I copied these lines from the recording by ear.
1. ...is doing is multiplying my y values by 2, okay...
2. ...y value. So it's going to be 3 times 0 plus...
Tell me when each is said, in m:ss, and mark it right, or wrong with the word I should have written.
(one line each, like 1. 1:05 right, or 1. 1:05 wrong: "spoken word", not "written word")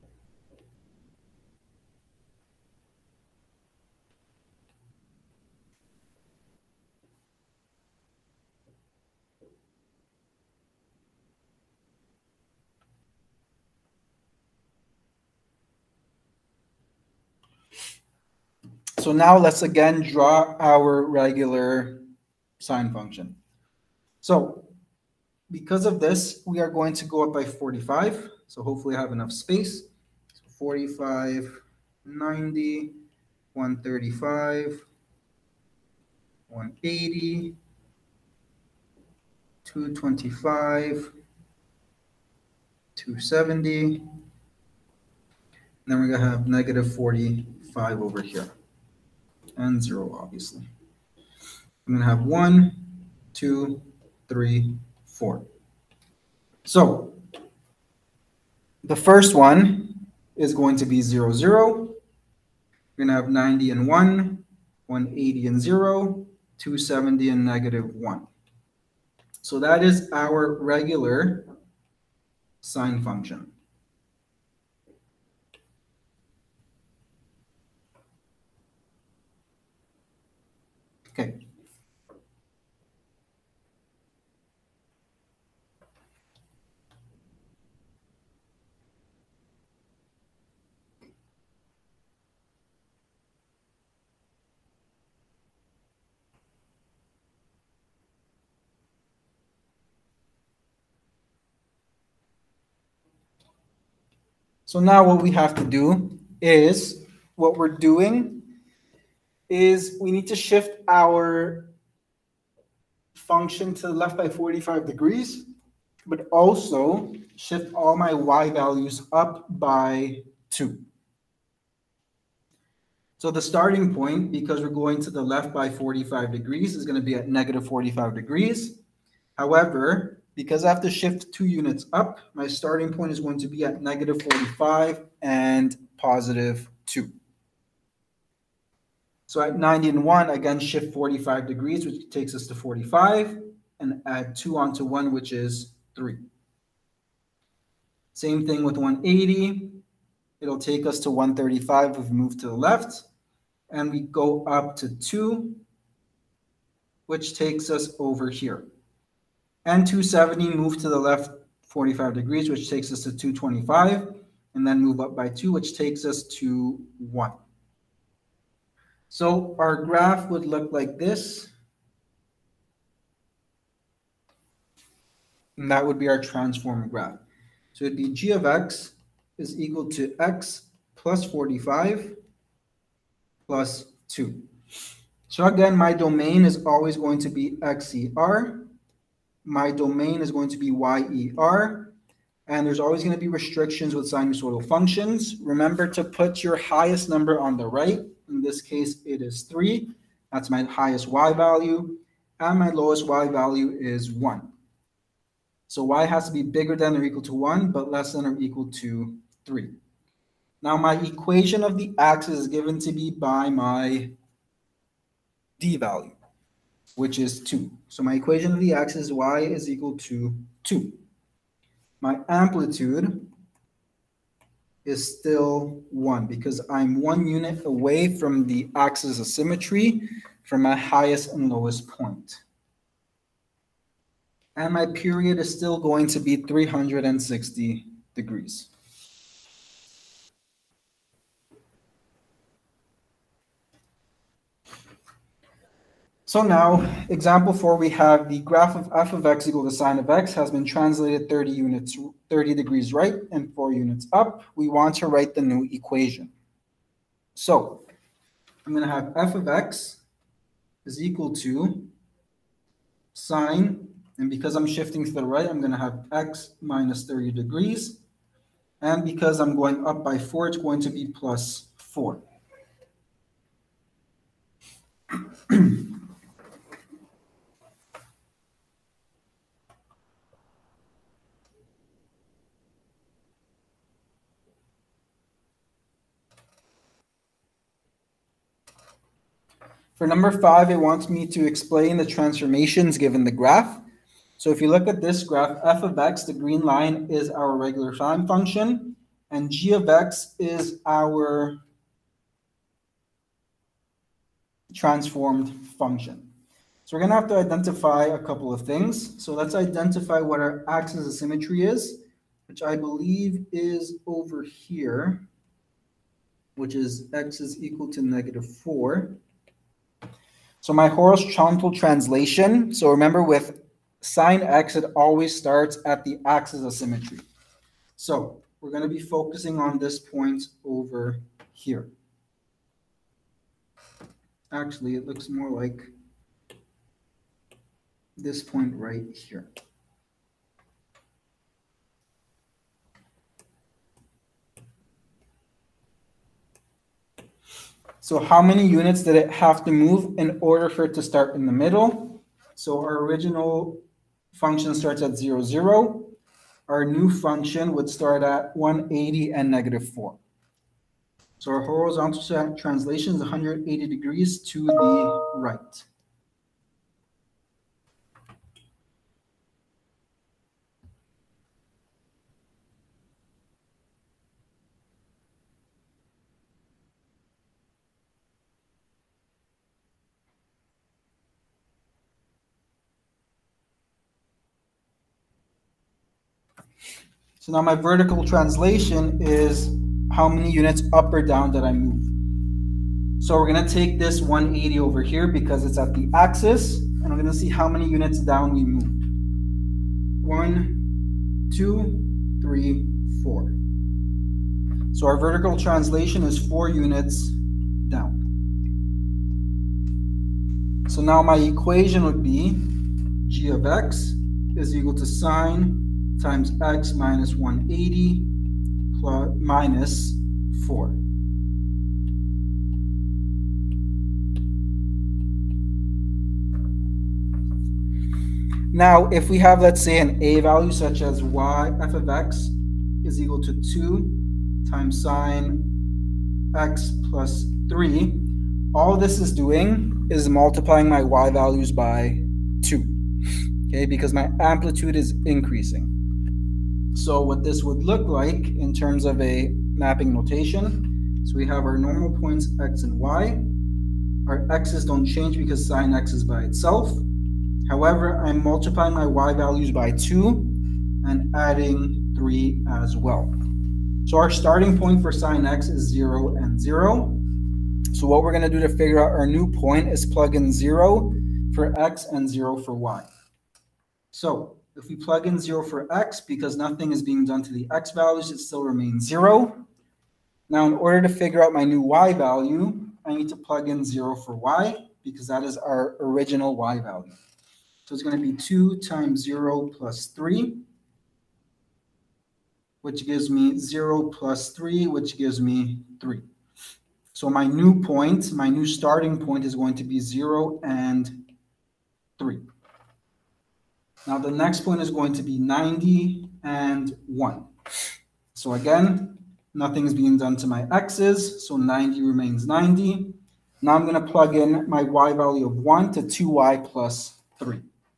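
1. 7:19 right
2. 8:06 wrong: "2", not "3".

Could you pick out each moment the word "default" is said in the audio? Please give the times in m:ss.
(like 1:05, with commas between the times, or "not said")
not said.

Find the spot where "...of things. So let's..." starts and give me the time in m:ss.
5:08.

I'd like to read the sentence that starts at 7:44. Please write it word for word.
So our starting point for sine x is 0 and 0.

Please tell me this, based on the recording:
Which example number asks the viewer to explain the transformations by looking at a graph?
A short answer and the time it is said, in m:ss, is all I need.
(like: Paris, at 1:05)
5, at 4:50.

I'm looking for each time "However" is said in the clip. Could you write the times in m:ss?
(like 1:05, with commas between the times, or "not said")
2:09, 7:37.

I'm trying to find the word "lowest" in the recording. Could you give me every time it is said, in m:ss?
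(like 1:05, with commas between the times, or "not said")
3:22, 3:51.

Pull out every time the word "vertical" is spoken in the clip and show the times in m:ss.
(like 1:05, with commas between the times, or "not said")
6:27, 6:45.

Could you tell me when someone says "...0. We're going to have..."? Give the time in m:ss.
1:01.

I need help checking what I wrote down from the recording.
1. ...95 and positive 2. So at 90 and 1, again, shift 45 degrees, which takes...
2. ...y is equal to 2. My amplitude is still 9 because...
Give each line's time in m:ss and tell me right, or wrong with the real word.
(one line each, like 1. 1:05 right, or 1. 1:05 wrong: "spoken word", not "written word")
1. 2:14 wrong: "45", not "95"
2. 3:39 wrong: "1", not "9".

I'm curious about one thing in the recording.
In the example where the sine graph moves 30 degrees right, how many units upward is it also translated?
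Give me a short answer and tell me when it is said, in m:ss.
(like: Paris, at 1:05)
4, at 4:13.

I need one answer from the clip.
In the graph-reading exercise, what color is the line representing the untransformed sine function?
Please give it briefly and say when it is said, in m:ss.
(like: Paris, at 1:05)
green, at 4:56.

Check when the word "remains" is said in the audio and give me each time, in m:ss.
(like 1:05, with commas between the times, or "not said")
7:58, 8:32.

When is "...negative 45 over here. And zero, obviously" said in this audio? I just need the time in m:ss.
0:46.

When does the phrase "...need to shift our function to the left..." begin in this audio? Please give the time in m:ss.
1:50.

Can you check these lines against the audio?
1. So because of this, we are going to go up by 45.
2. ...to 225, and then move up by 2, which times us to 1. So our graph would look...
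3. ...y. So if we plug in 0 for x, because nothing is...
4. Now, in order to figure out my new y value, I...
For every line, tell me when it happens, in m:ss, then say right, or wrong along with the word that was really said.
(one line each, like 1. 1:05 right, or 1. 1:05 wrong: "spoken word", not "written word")
1. 0:24 right
2. 2:43 wrong: "takes", not "times"
3. 7:52 right
4. 8:00 right.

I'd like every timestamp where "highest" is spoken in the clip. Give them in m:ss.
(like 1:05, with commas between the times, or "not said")
3:16, 3:20, 3:50.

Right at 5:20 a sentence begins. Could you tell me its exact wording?
So my horizontal translation, so remember with sine x, it always starts at the axis of symmetry.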